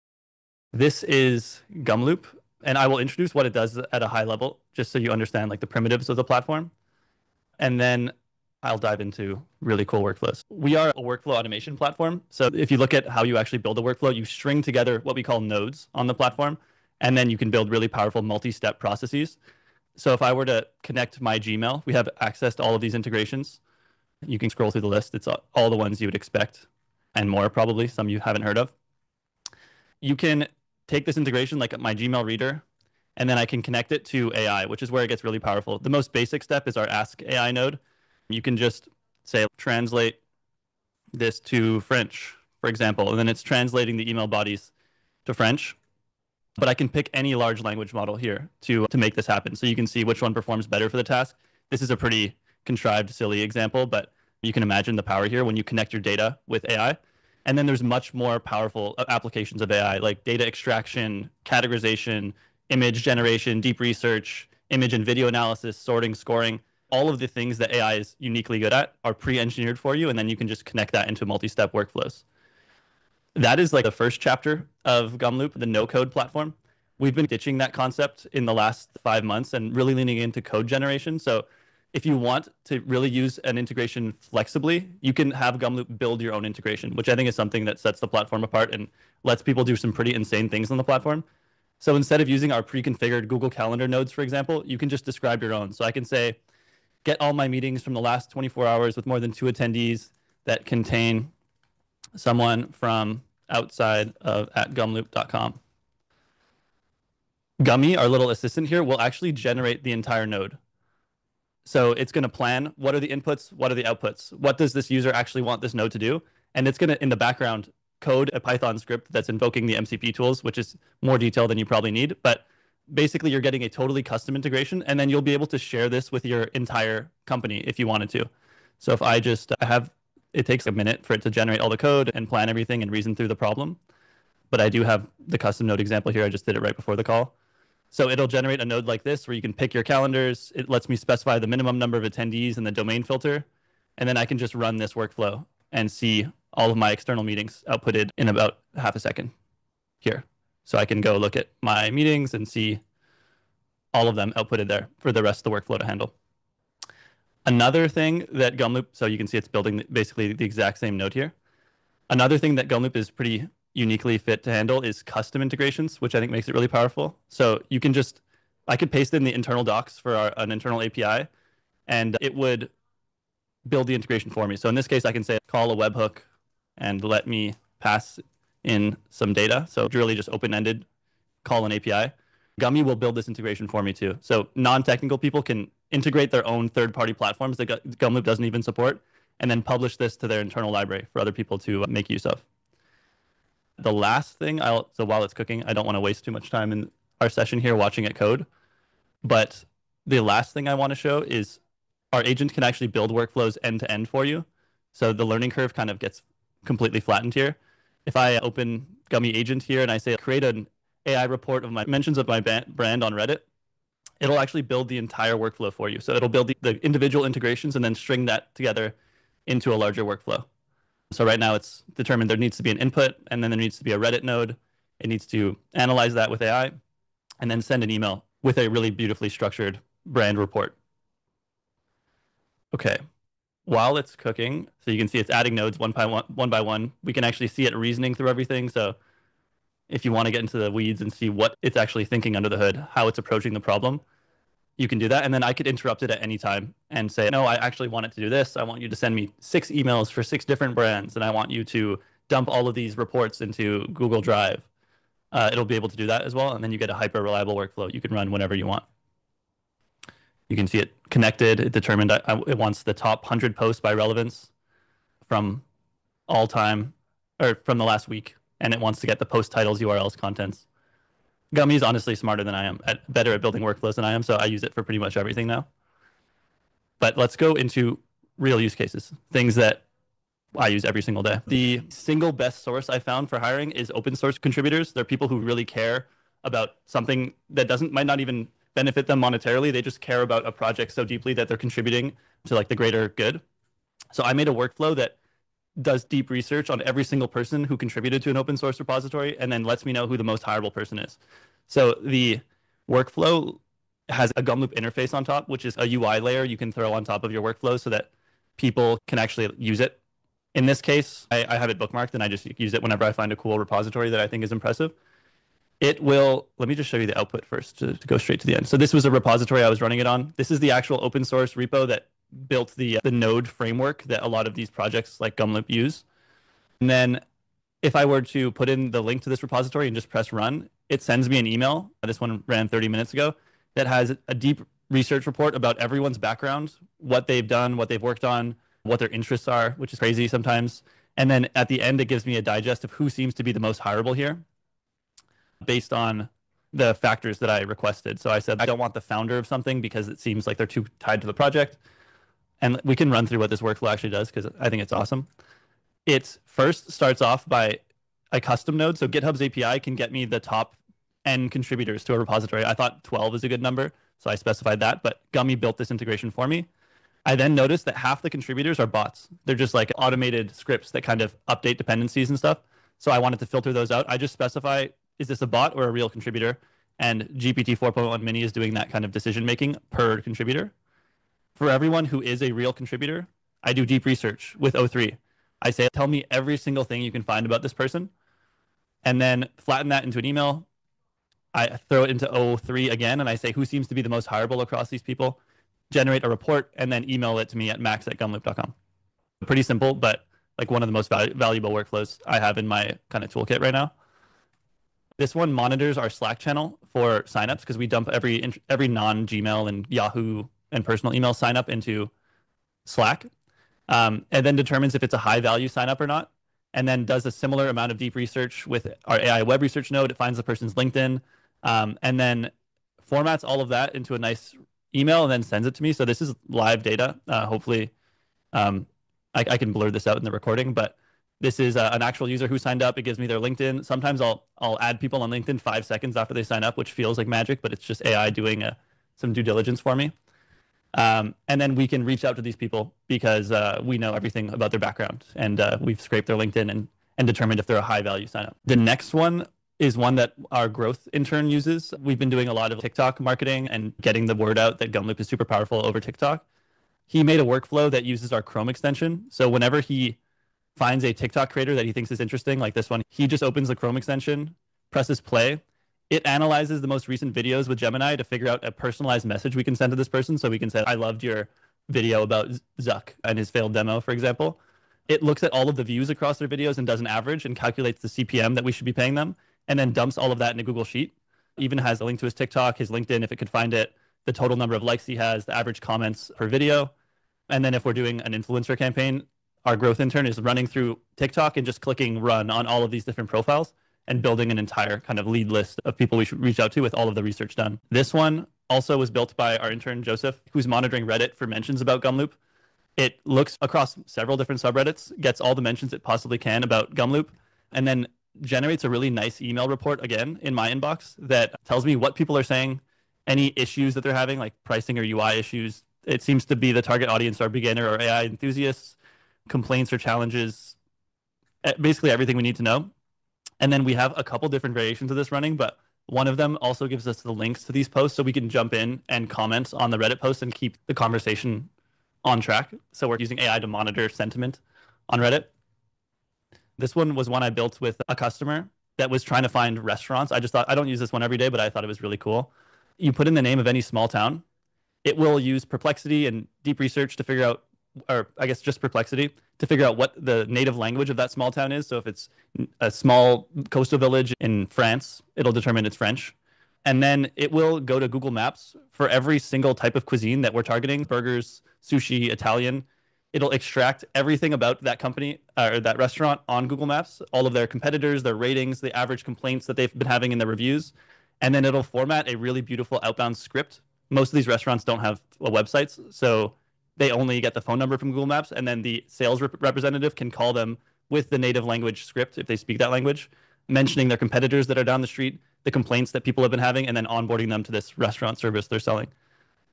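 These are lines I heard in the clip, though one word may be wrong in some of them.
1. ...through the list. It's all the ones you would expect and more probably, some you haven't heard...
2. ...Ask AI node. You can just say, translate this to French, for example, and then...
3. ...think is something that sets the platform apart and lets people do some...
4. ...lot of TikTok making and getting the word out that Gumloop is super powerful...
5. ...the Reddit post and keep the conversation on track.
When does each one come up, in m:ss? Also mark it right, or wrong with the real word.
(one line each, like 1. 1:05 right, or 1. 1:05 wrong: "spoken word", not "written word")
1. 0:24 right
2. 0:36 right
3. 1:27 right
4. 7:32 wrong: "marketing", not "making"
5. 8:49 right.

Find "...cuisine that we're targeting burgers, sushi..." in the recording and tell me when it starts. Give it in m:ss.
9:20.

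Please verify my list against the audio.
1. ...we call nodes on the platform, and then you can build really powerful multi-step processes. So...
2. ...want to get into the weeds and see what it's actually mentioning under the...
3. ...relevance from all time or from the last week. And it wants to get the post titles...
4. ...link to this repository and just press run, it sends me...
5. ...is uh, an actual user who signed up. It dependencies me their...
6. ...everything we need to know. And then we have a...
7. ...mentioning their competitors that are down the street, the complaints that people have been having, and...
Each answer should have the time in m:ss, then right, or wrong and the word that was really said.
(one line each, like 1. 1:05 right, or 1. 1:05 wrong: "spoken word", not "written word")
1. 0:15 right
2. 4:00 wrong: "thinking", not "mentioning"
3. 4:23 right
4. 5:29 right
5. 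7:11 wrong: "gives", not "dependencies"
6. 8:42 right
7. 9:43 right.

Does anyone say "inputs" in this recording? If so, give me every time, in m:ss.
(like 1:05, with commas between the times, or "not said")
1:53, 3:42.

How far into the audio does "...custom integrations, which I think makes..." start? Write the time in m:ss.
2:45.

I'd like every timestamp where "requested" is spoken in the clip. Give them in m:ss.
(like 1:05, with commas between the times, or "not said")
5:47.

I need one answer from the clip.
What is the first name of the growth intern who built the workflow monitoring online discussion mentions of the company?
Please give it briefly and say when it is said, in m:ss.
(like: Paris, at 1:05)
Joseph, at 8:20.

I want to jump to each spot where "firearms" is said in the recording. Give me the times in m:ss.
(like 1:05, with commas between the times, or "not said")
not said.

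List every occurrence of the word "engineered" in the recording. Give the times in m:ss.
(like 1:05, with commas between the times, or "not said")
1:09.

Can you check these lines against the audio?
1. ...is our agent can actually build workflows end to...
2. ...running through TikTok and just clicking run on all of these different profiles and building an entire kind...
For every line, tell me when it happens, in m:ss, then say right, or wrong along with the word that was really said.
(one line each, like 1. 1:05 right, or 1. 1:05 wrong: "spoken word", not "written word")
1. 3:21 right
2. 8:10 right.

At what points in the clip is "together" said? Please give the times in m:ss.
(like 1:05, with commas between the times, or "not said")
0:14, 3:38.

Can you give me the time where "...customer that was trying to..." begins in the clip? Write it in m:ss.
8:58.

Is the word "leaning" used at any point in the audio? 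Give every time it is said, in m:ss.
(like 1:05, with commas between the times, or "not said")
1:19.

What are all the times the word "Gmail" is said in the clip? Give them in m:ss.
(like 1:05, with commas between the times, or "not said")
0:21, 0:31, 6:49.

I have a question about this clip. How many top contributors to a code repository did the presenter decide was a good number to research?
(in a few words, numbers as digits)
12.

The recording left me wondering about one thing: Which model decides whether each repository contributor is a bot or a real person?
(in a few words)
GPT 4.1 mini.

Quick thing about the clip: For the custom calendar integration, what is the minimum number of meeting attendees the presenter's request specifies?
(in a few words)
2.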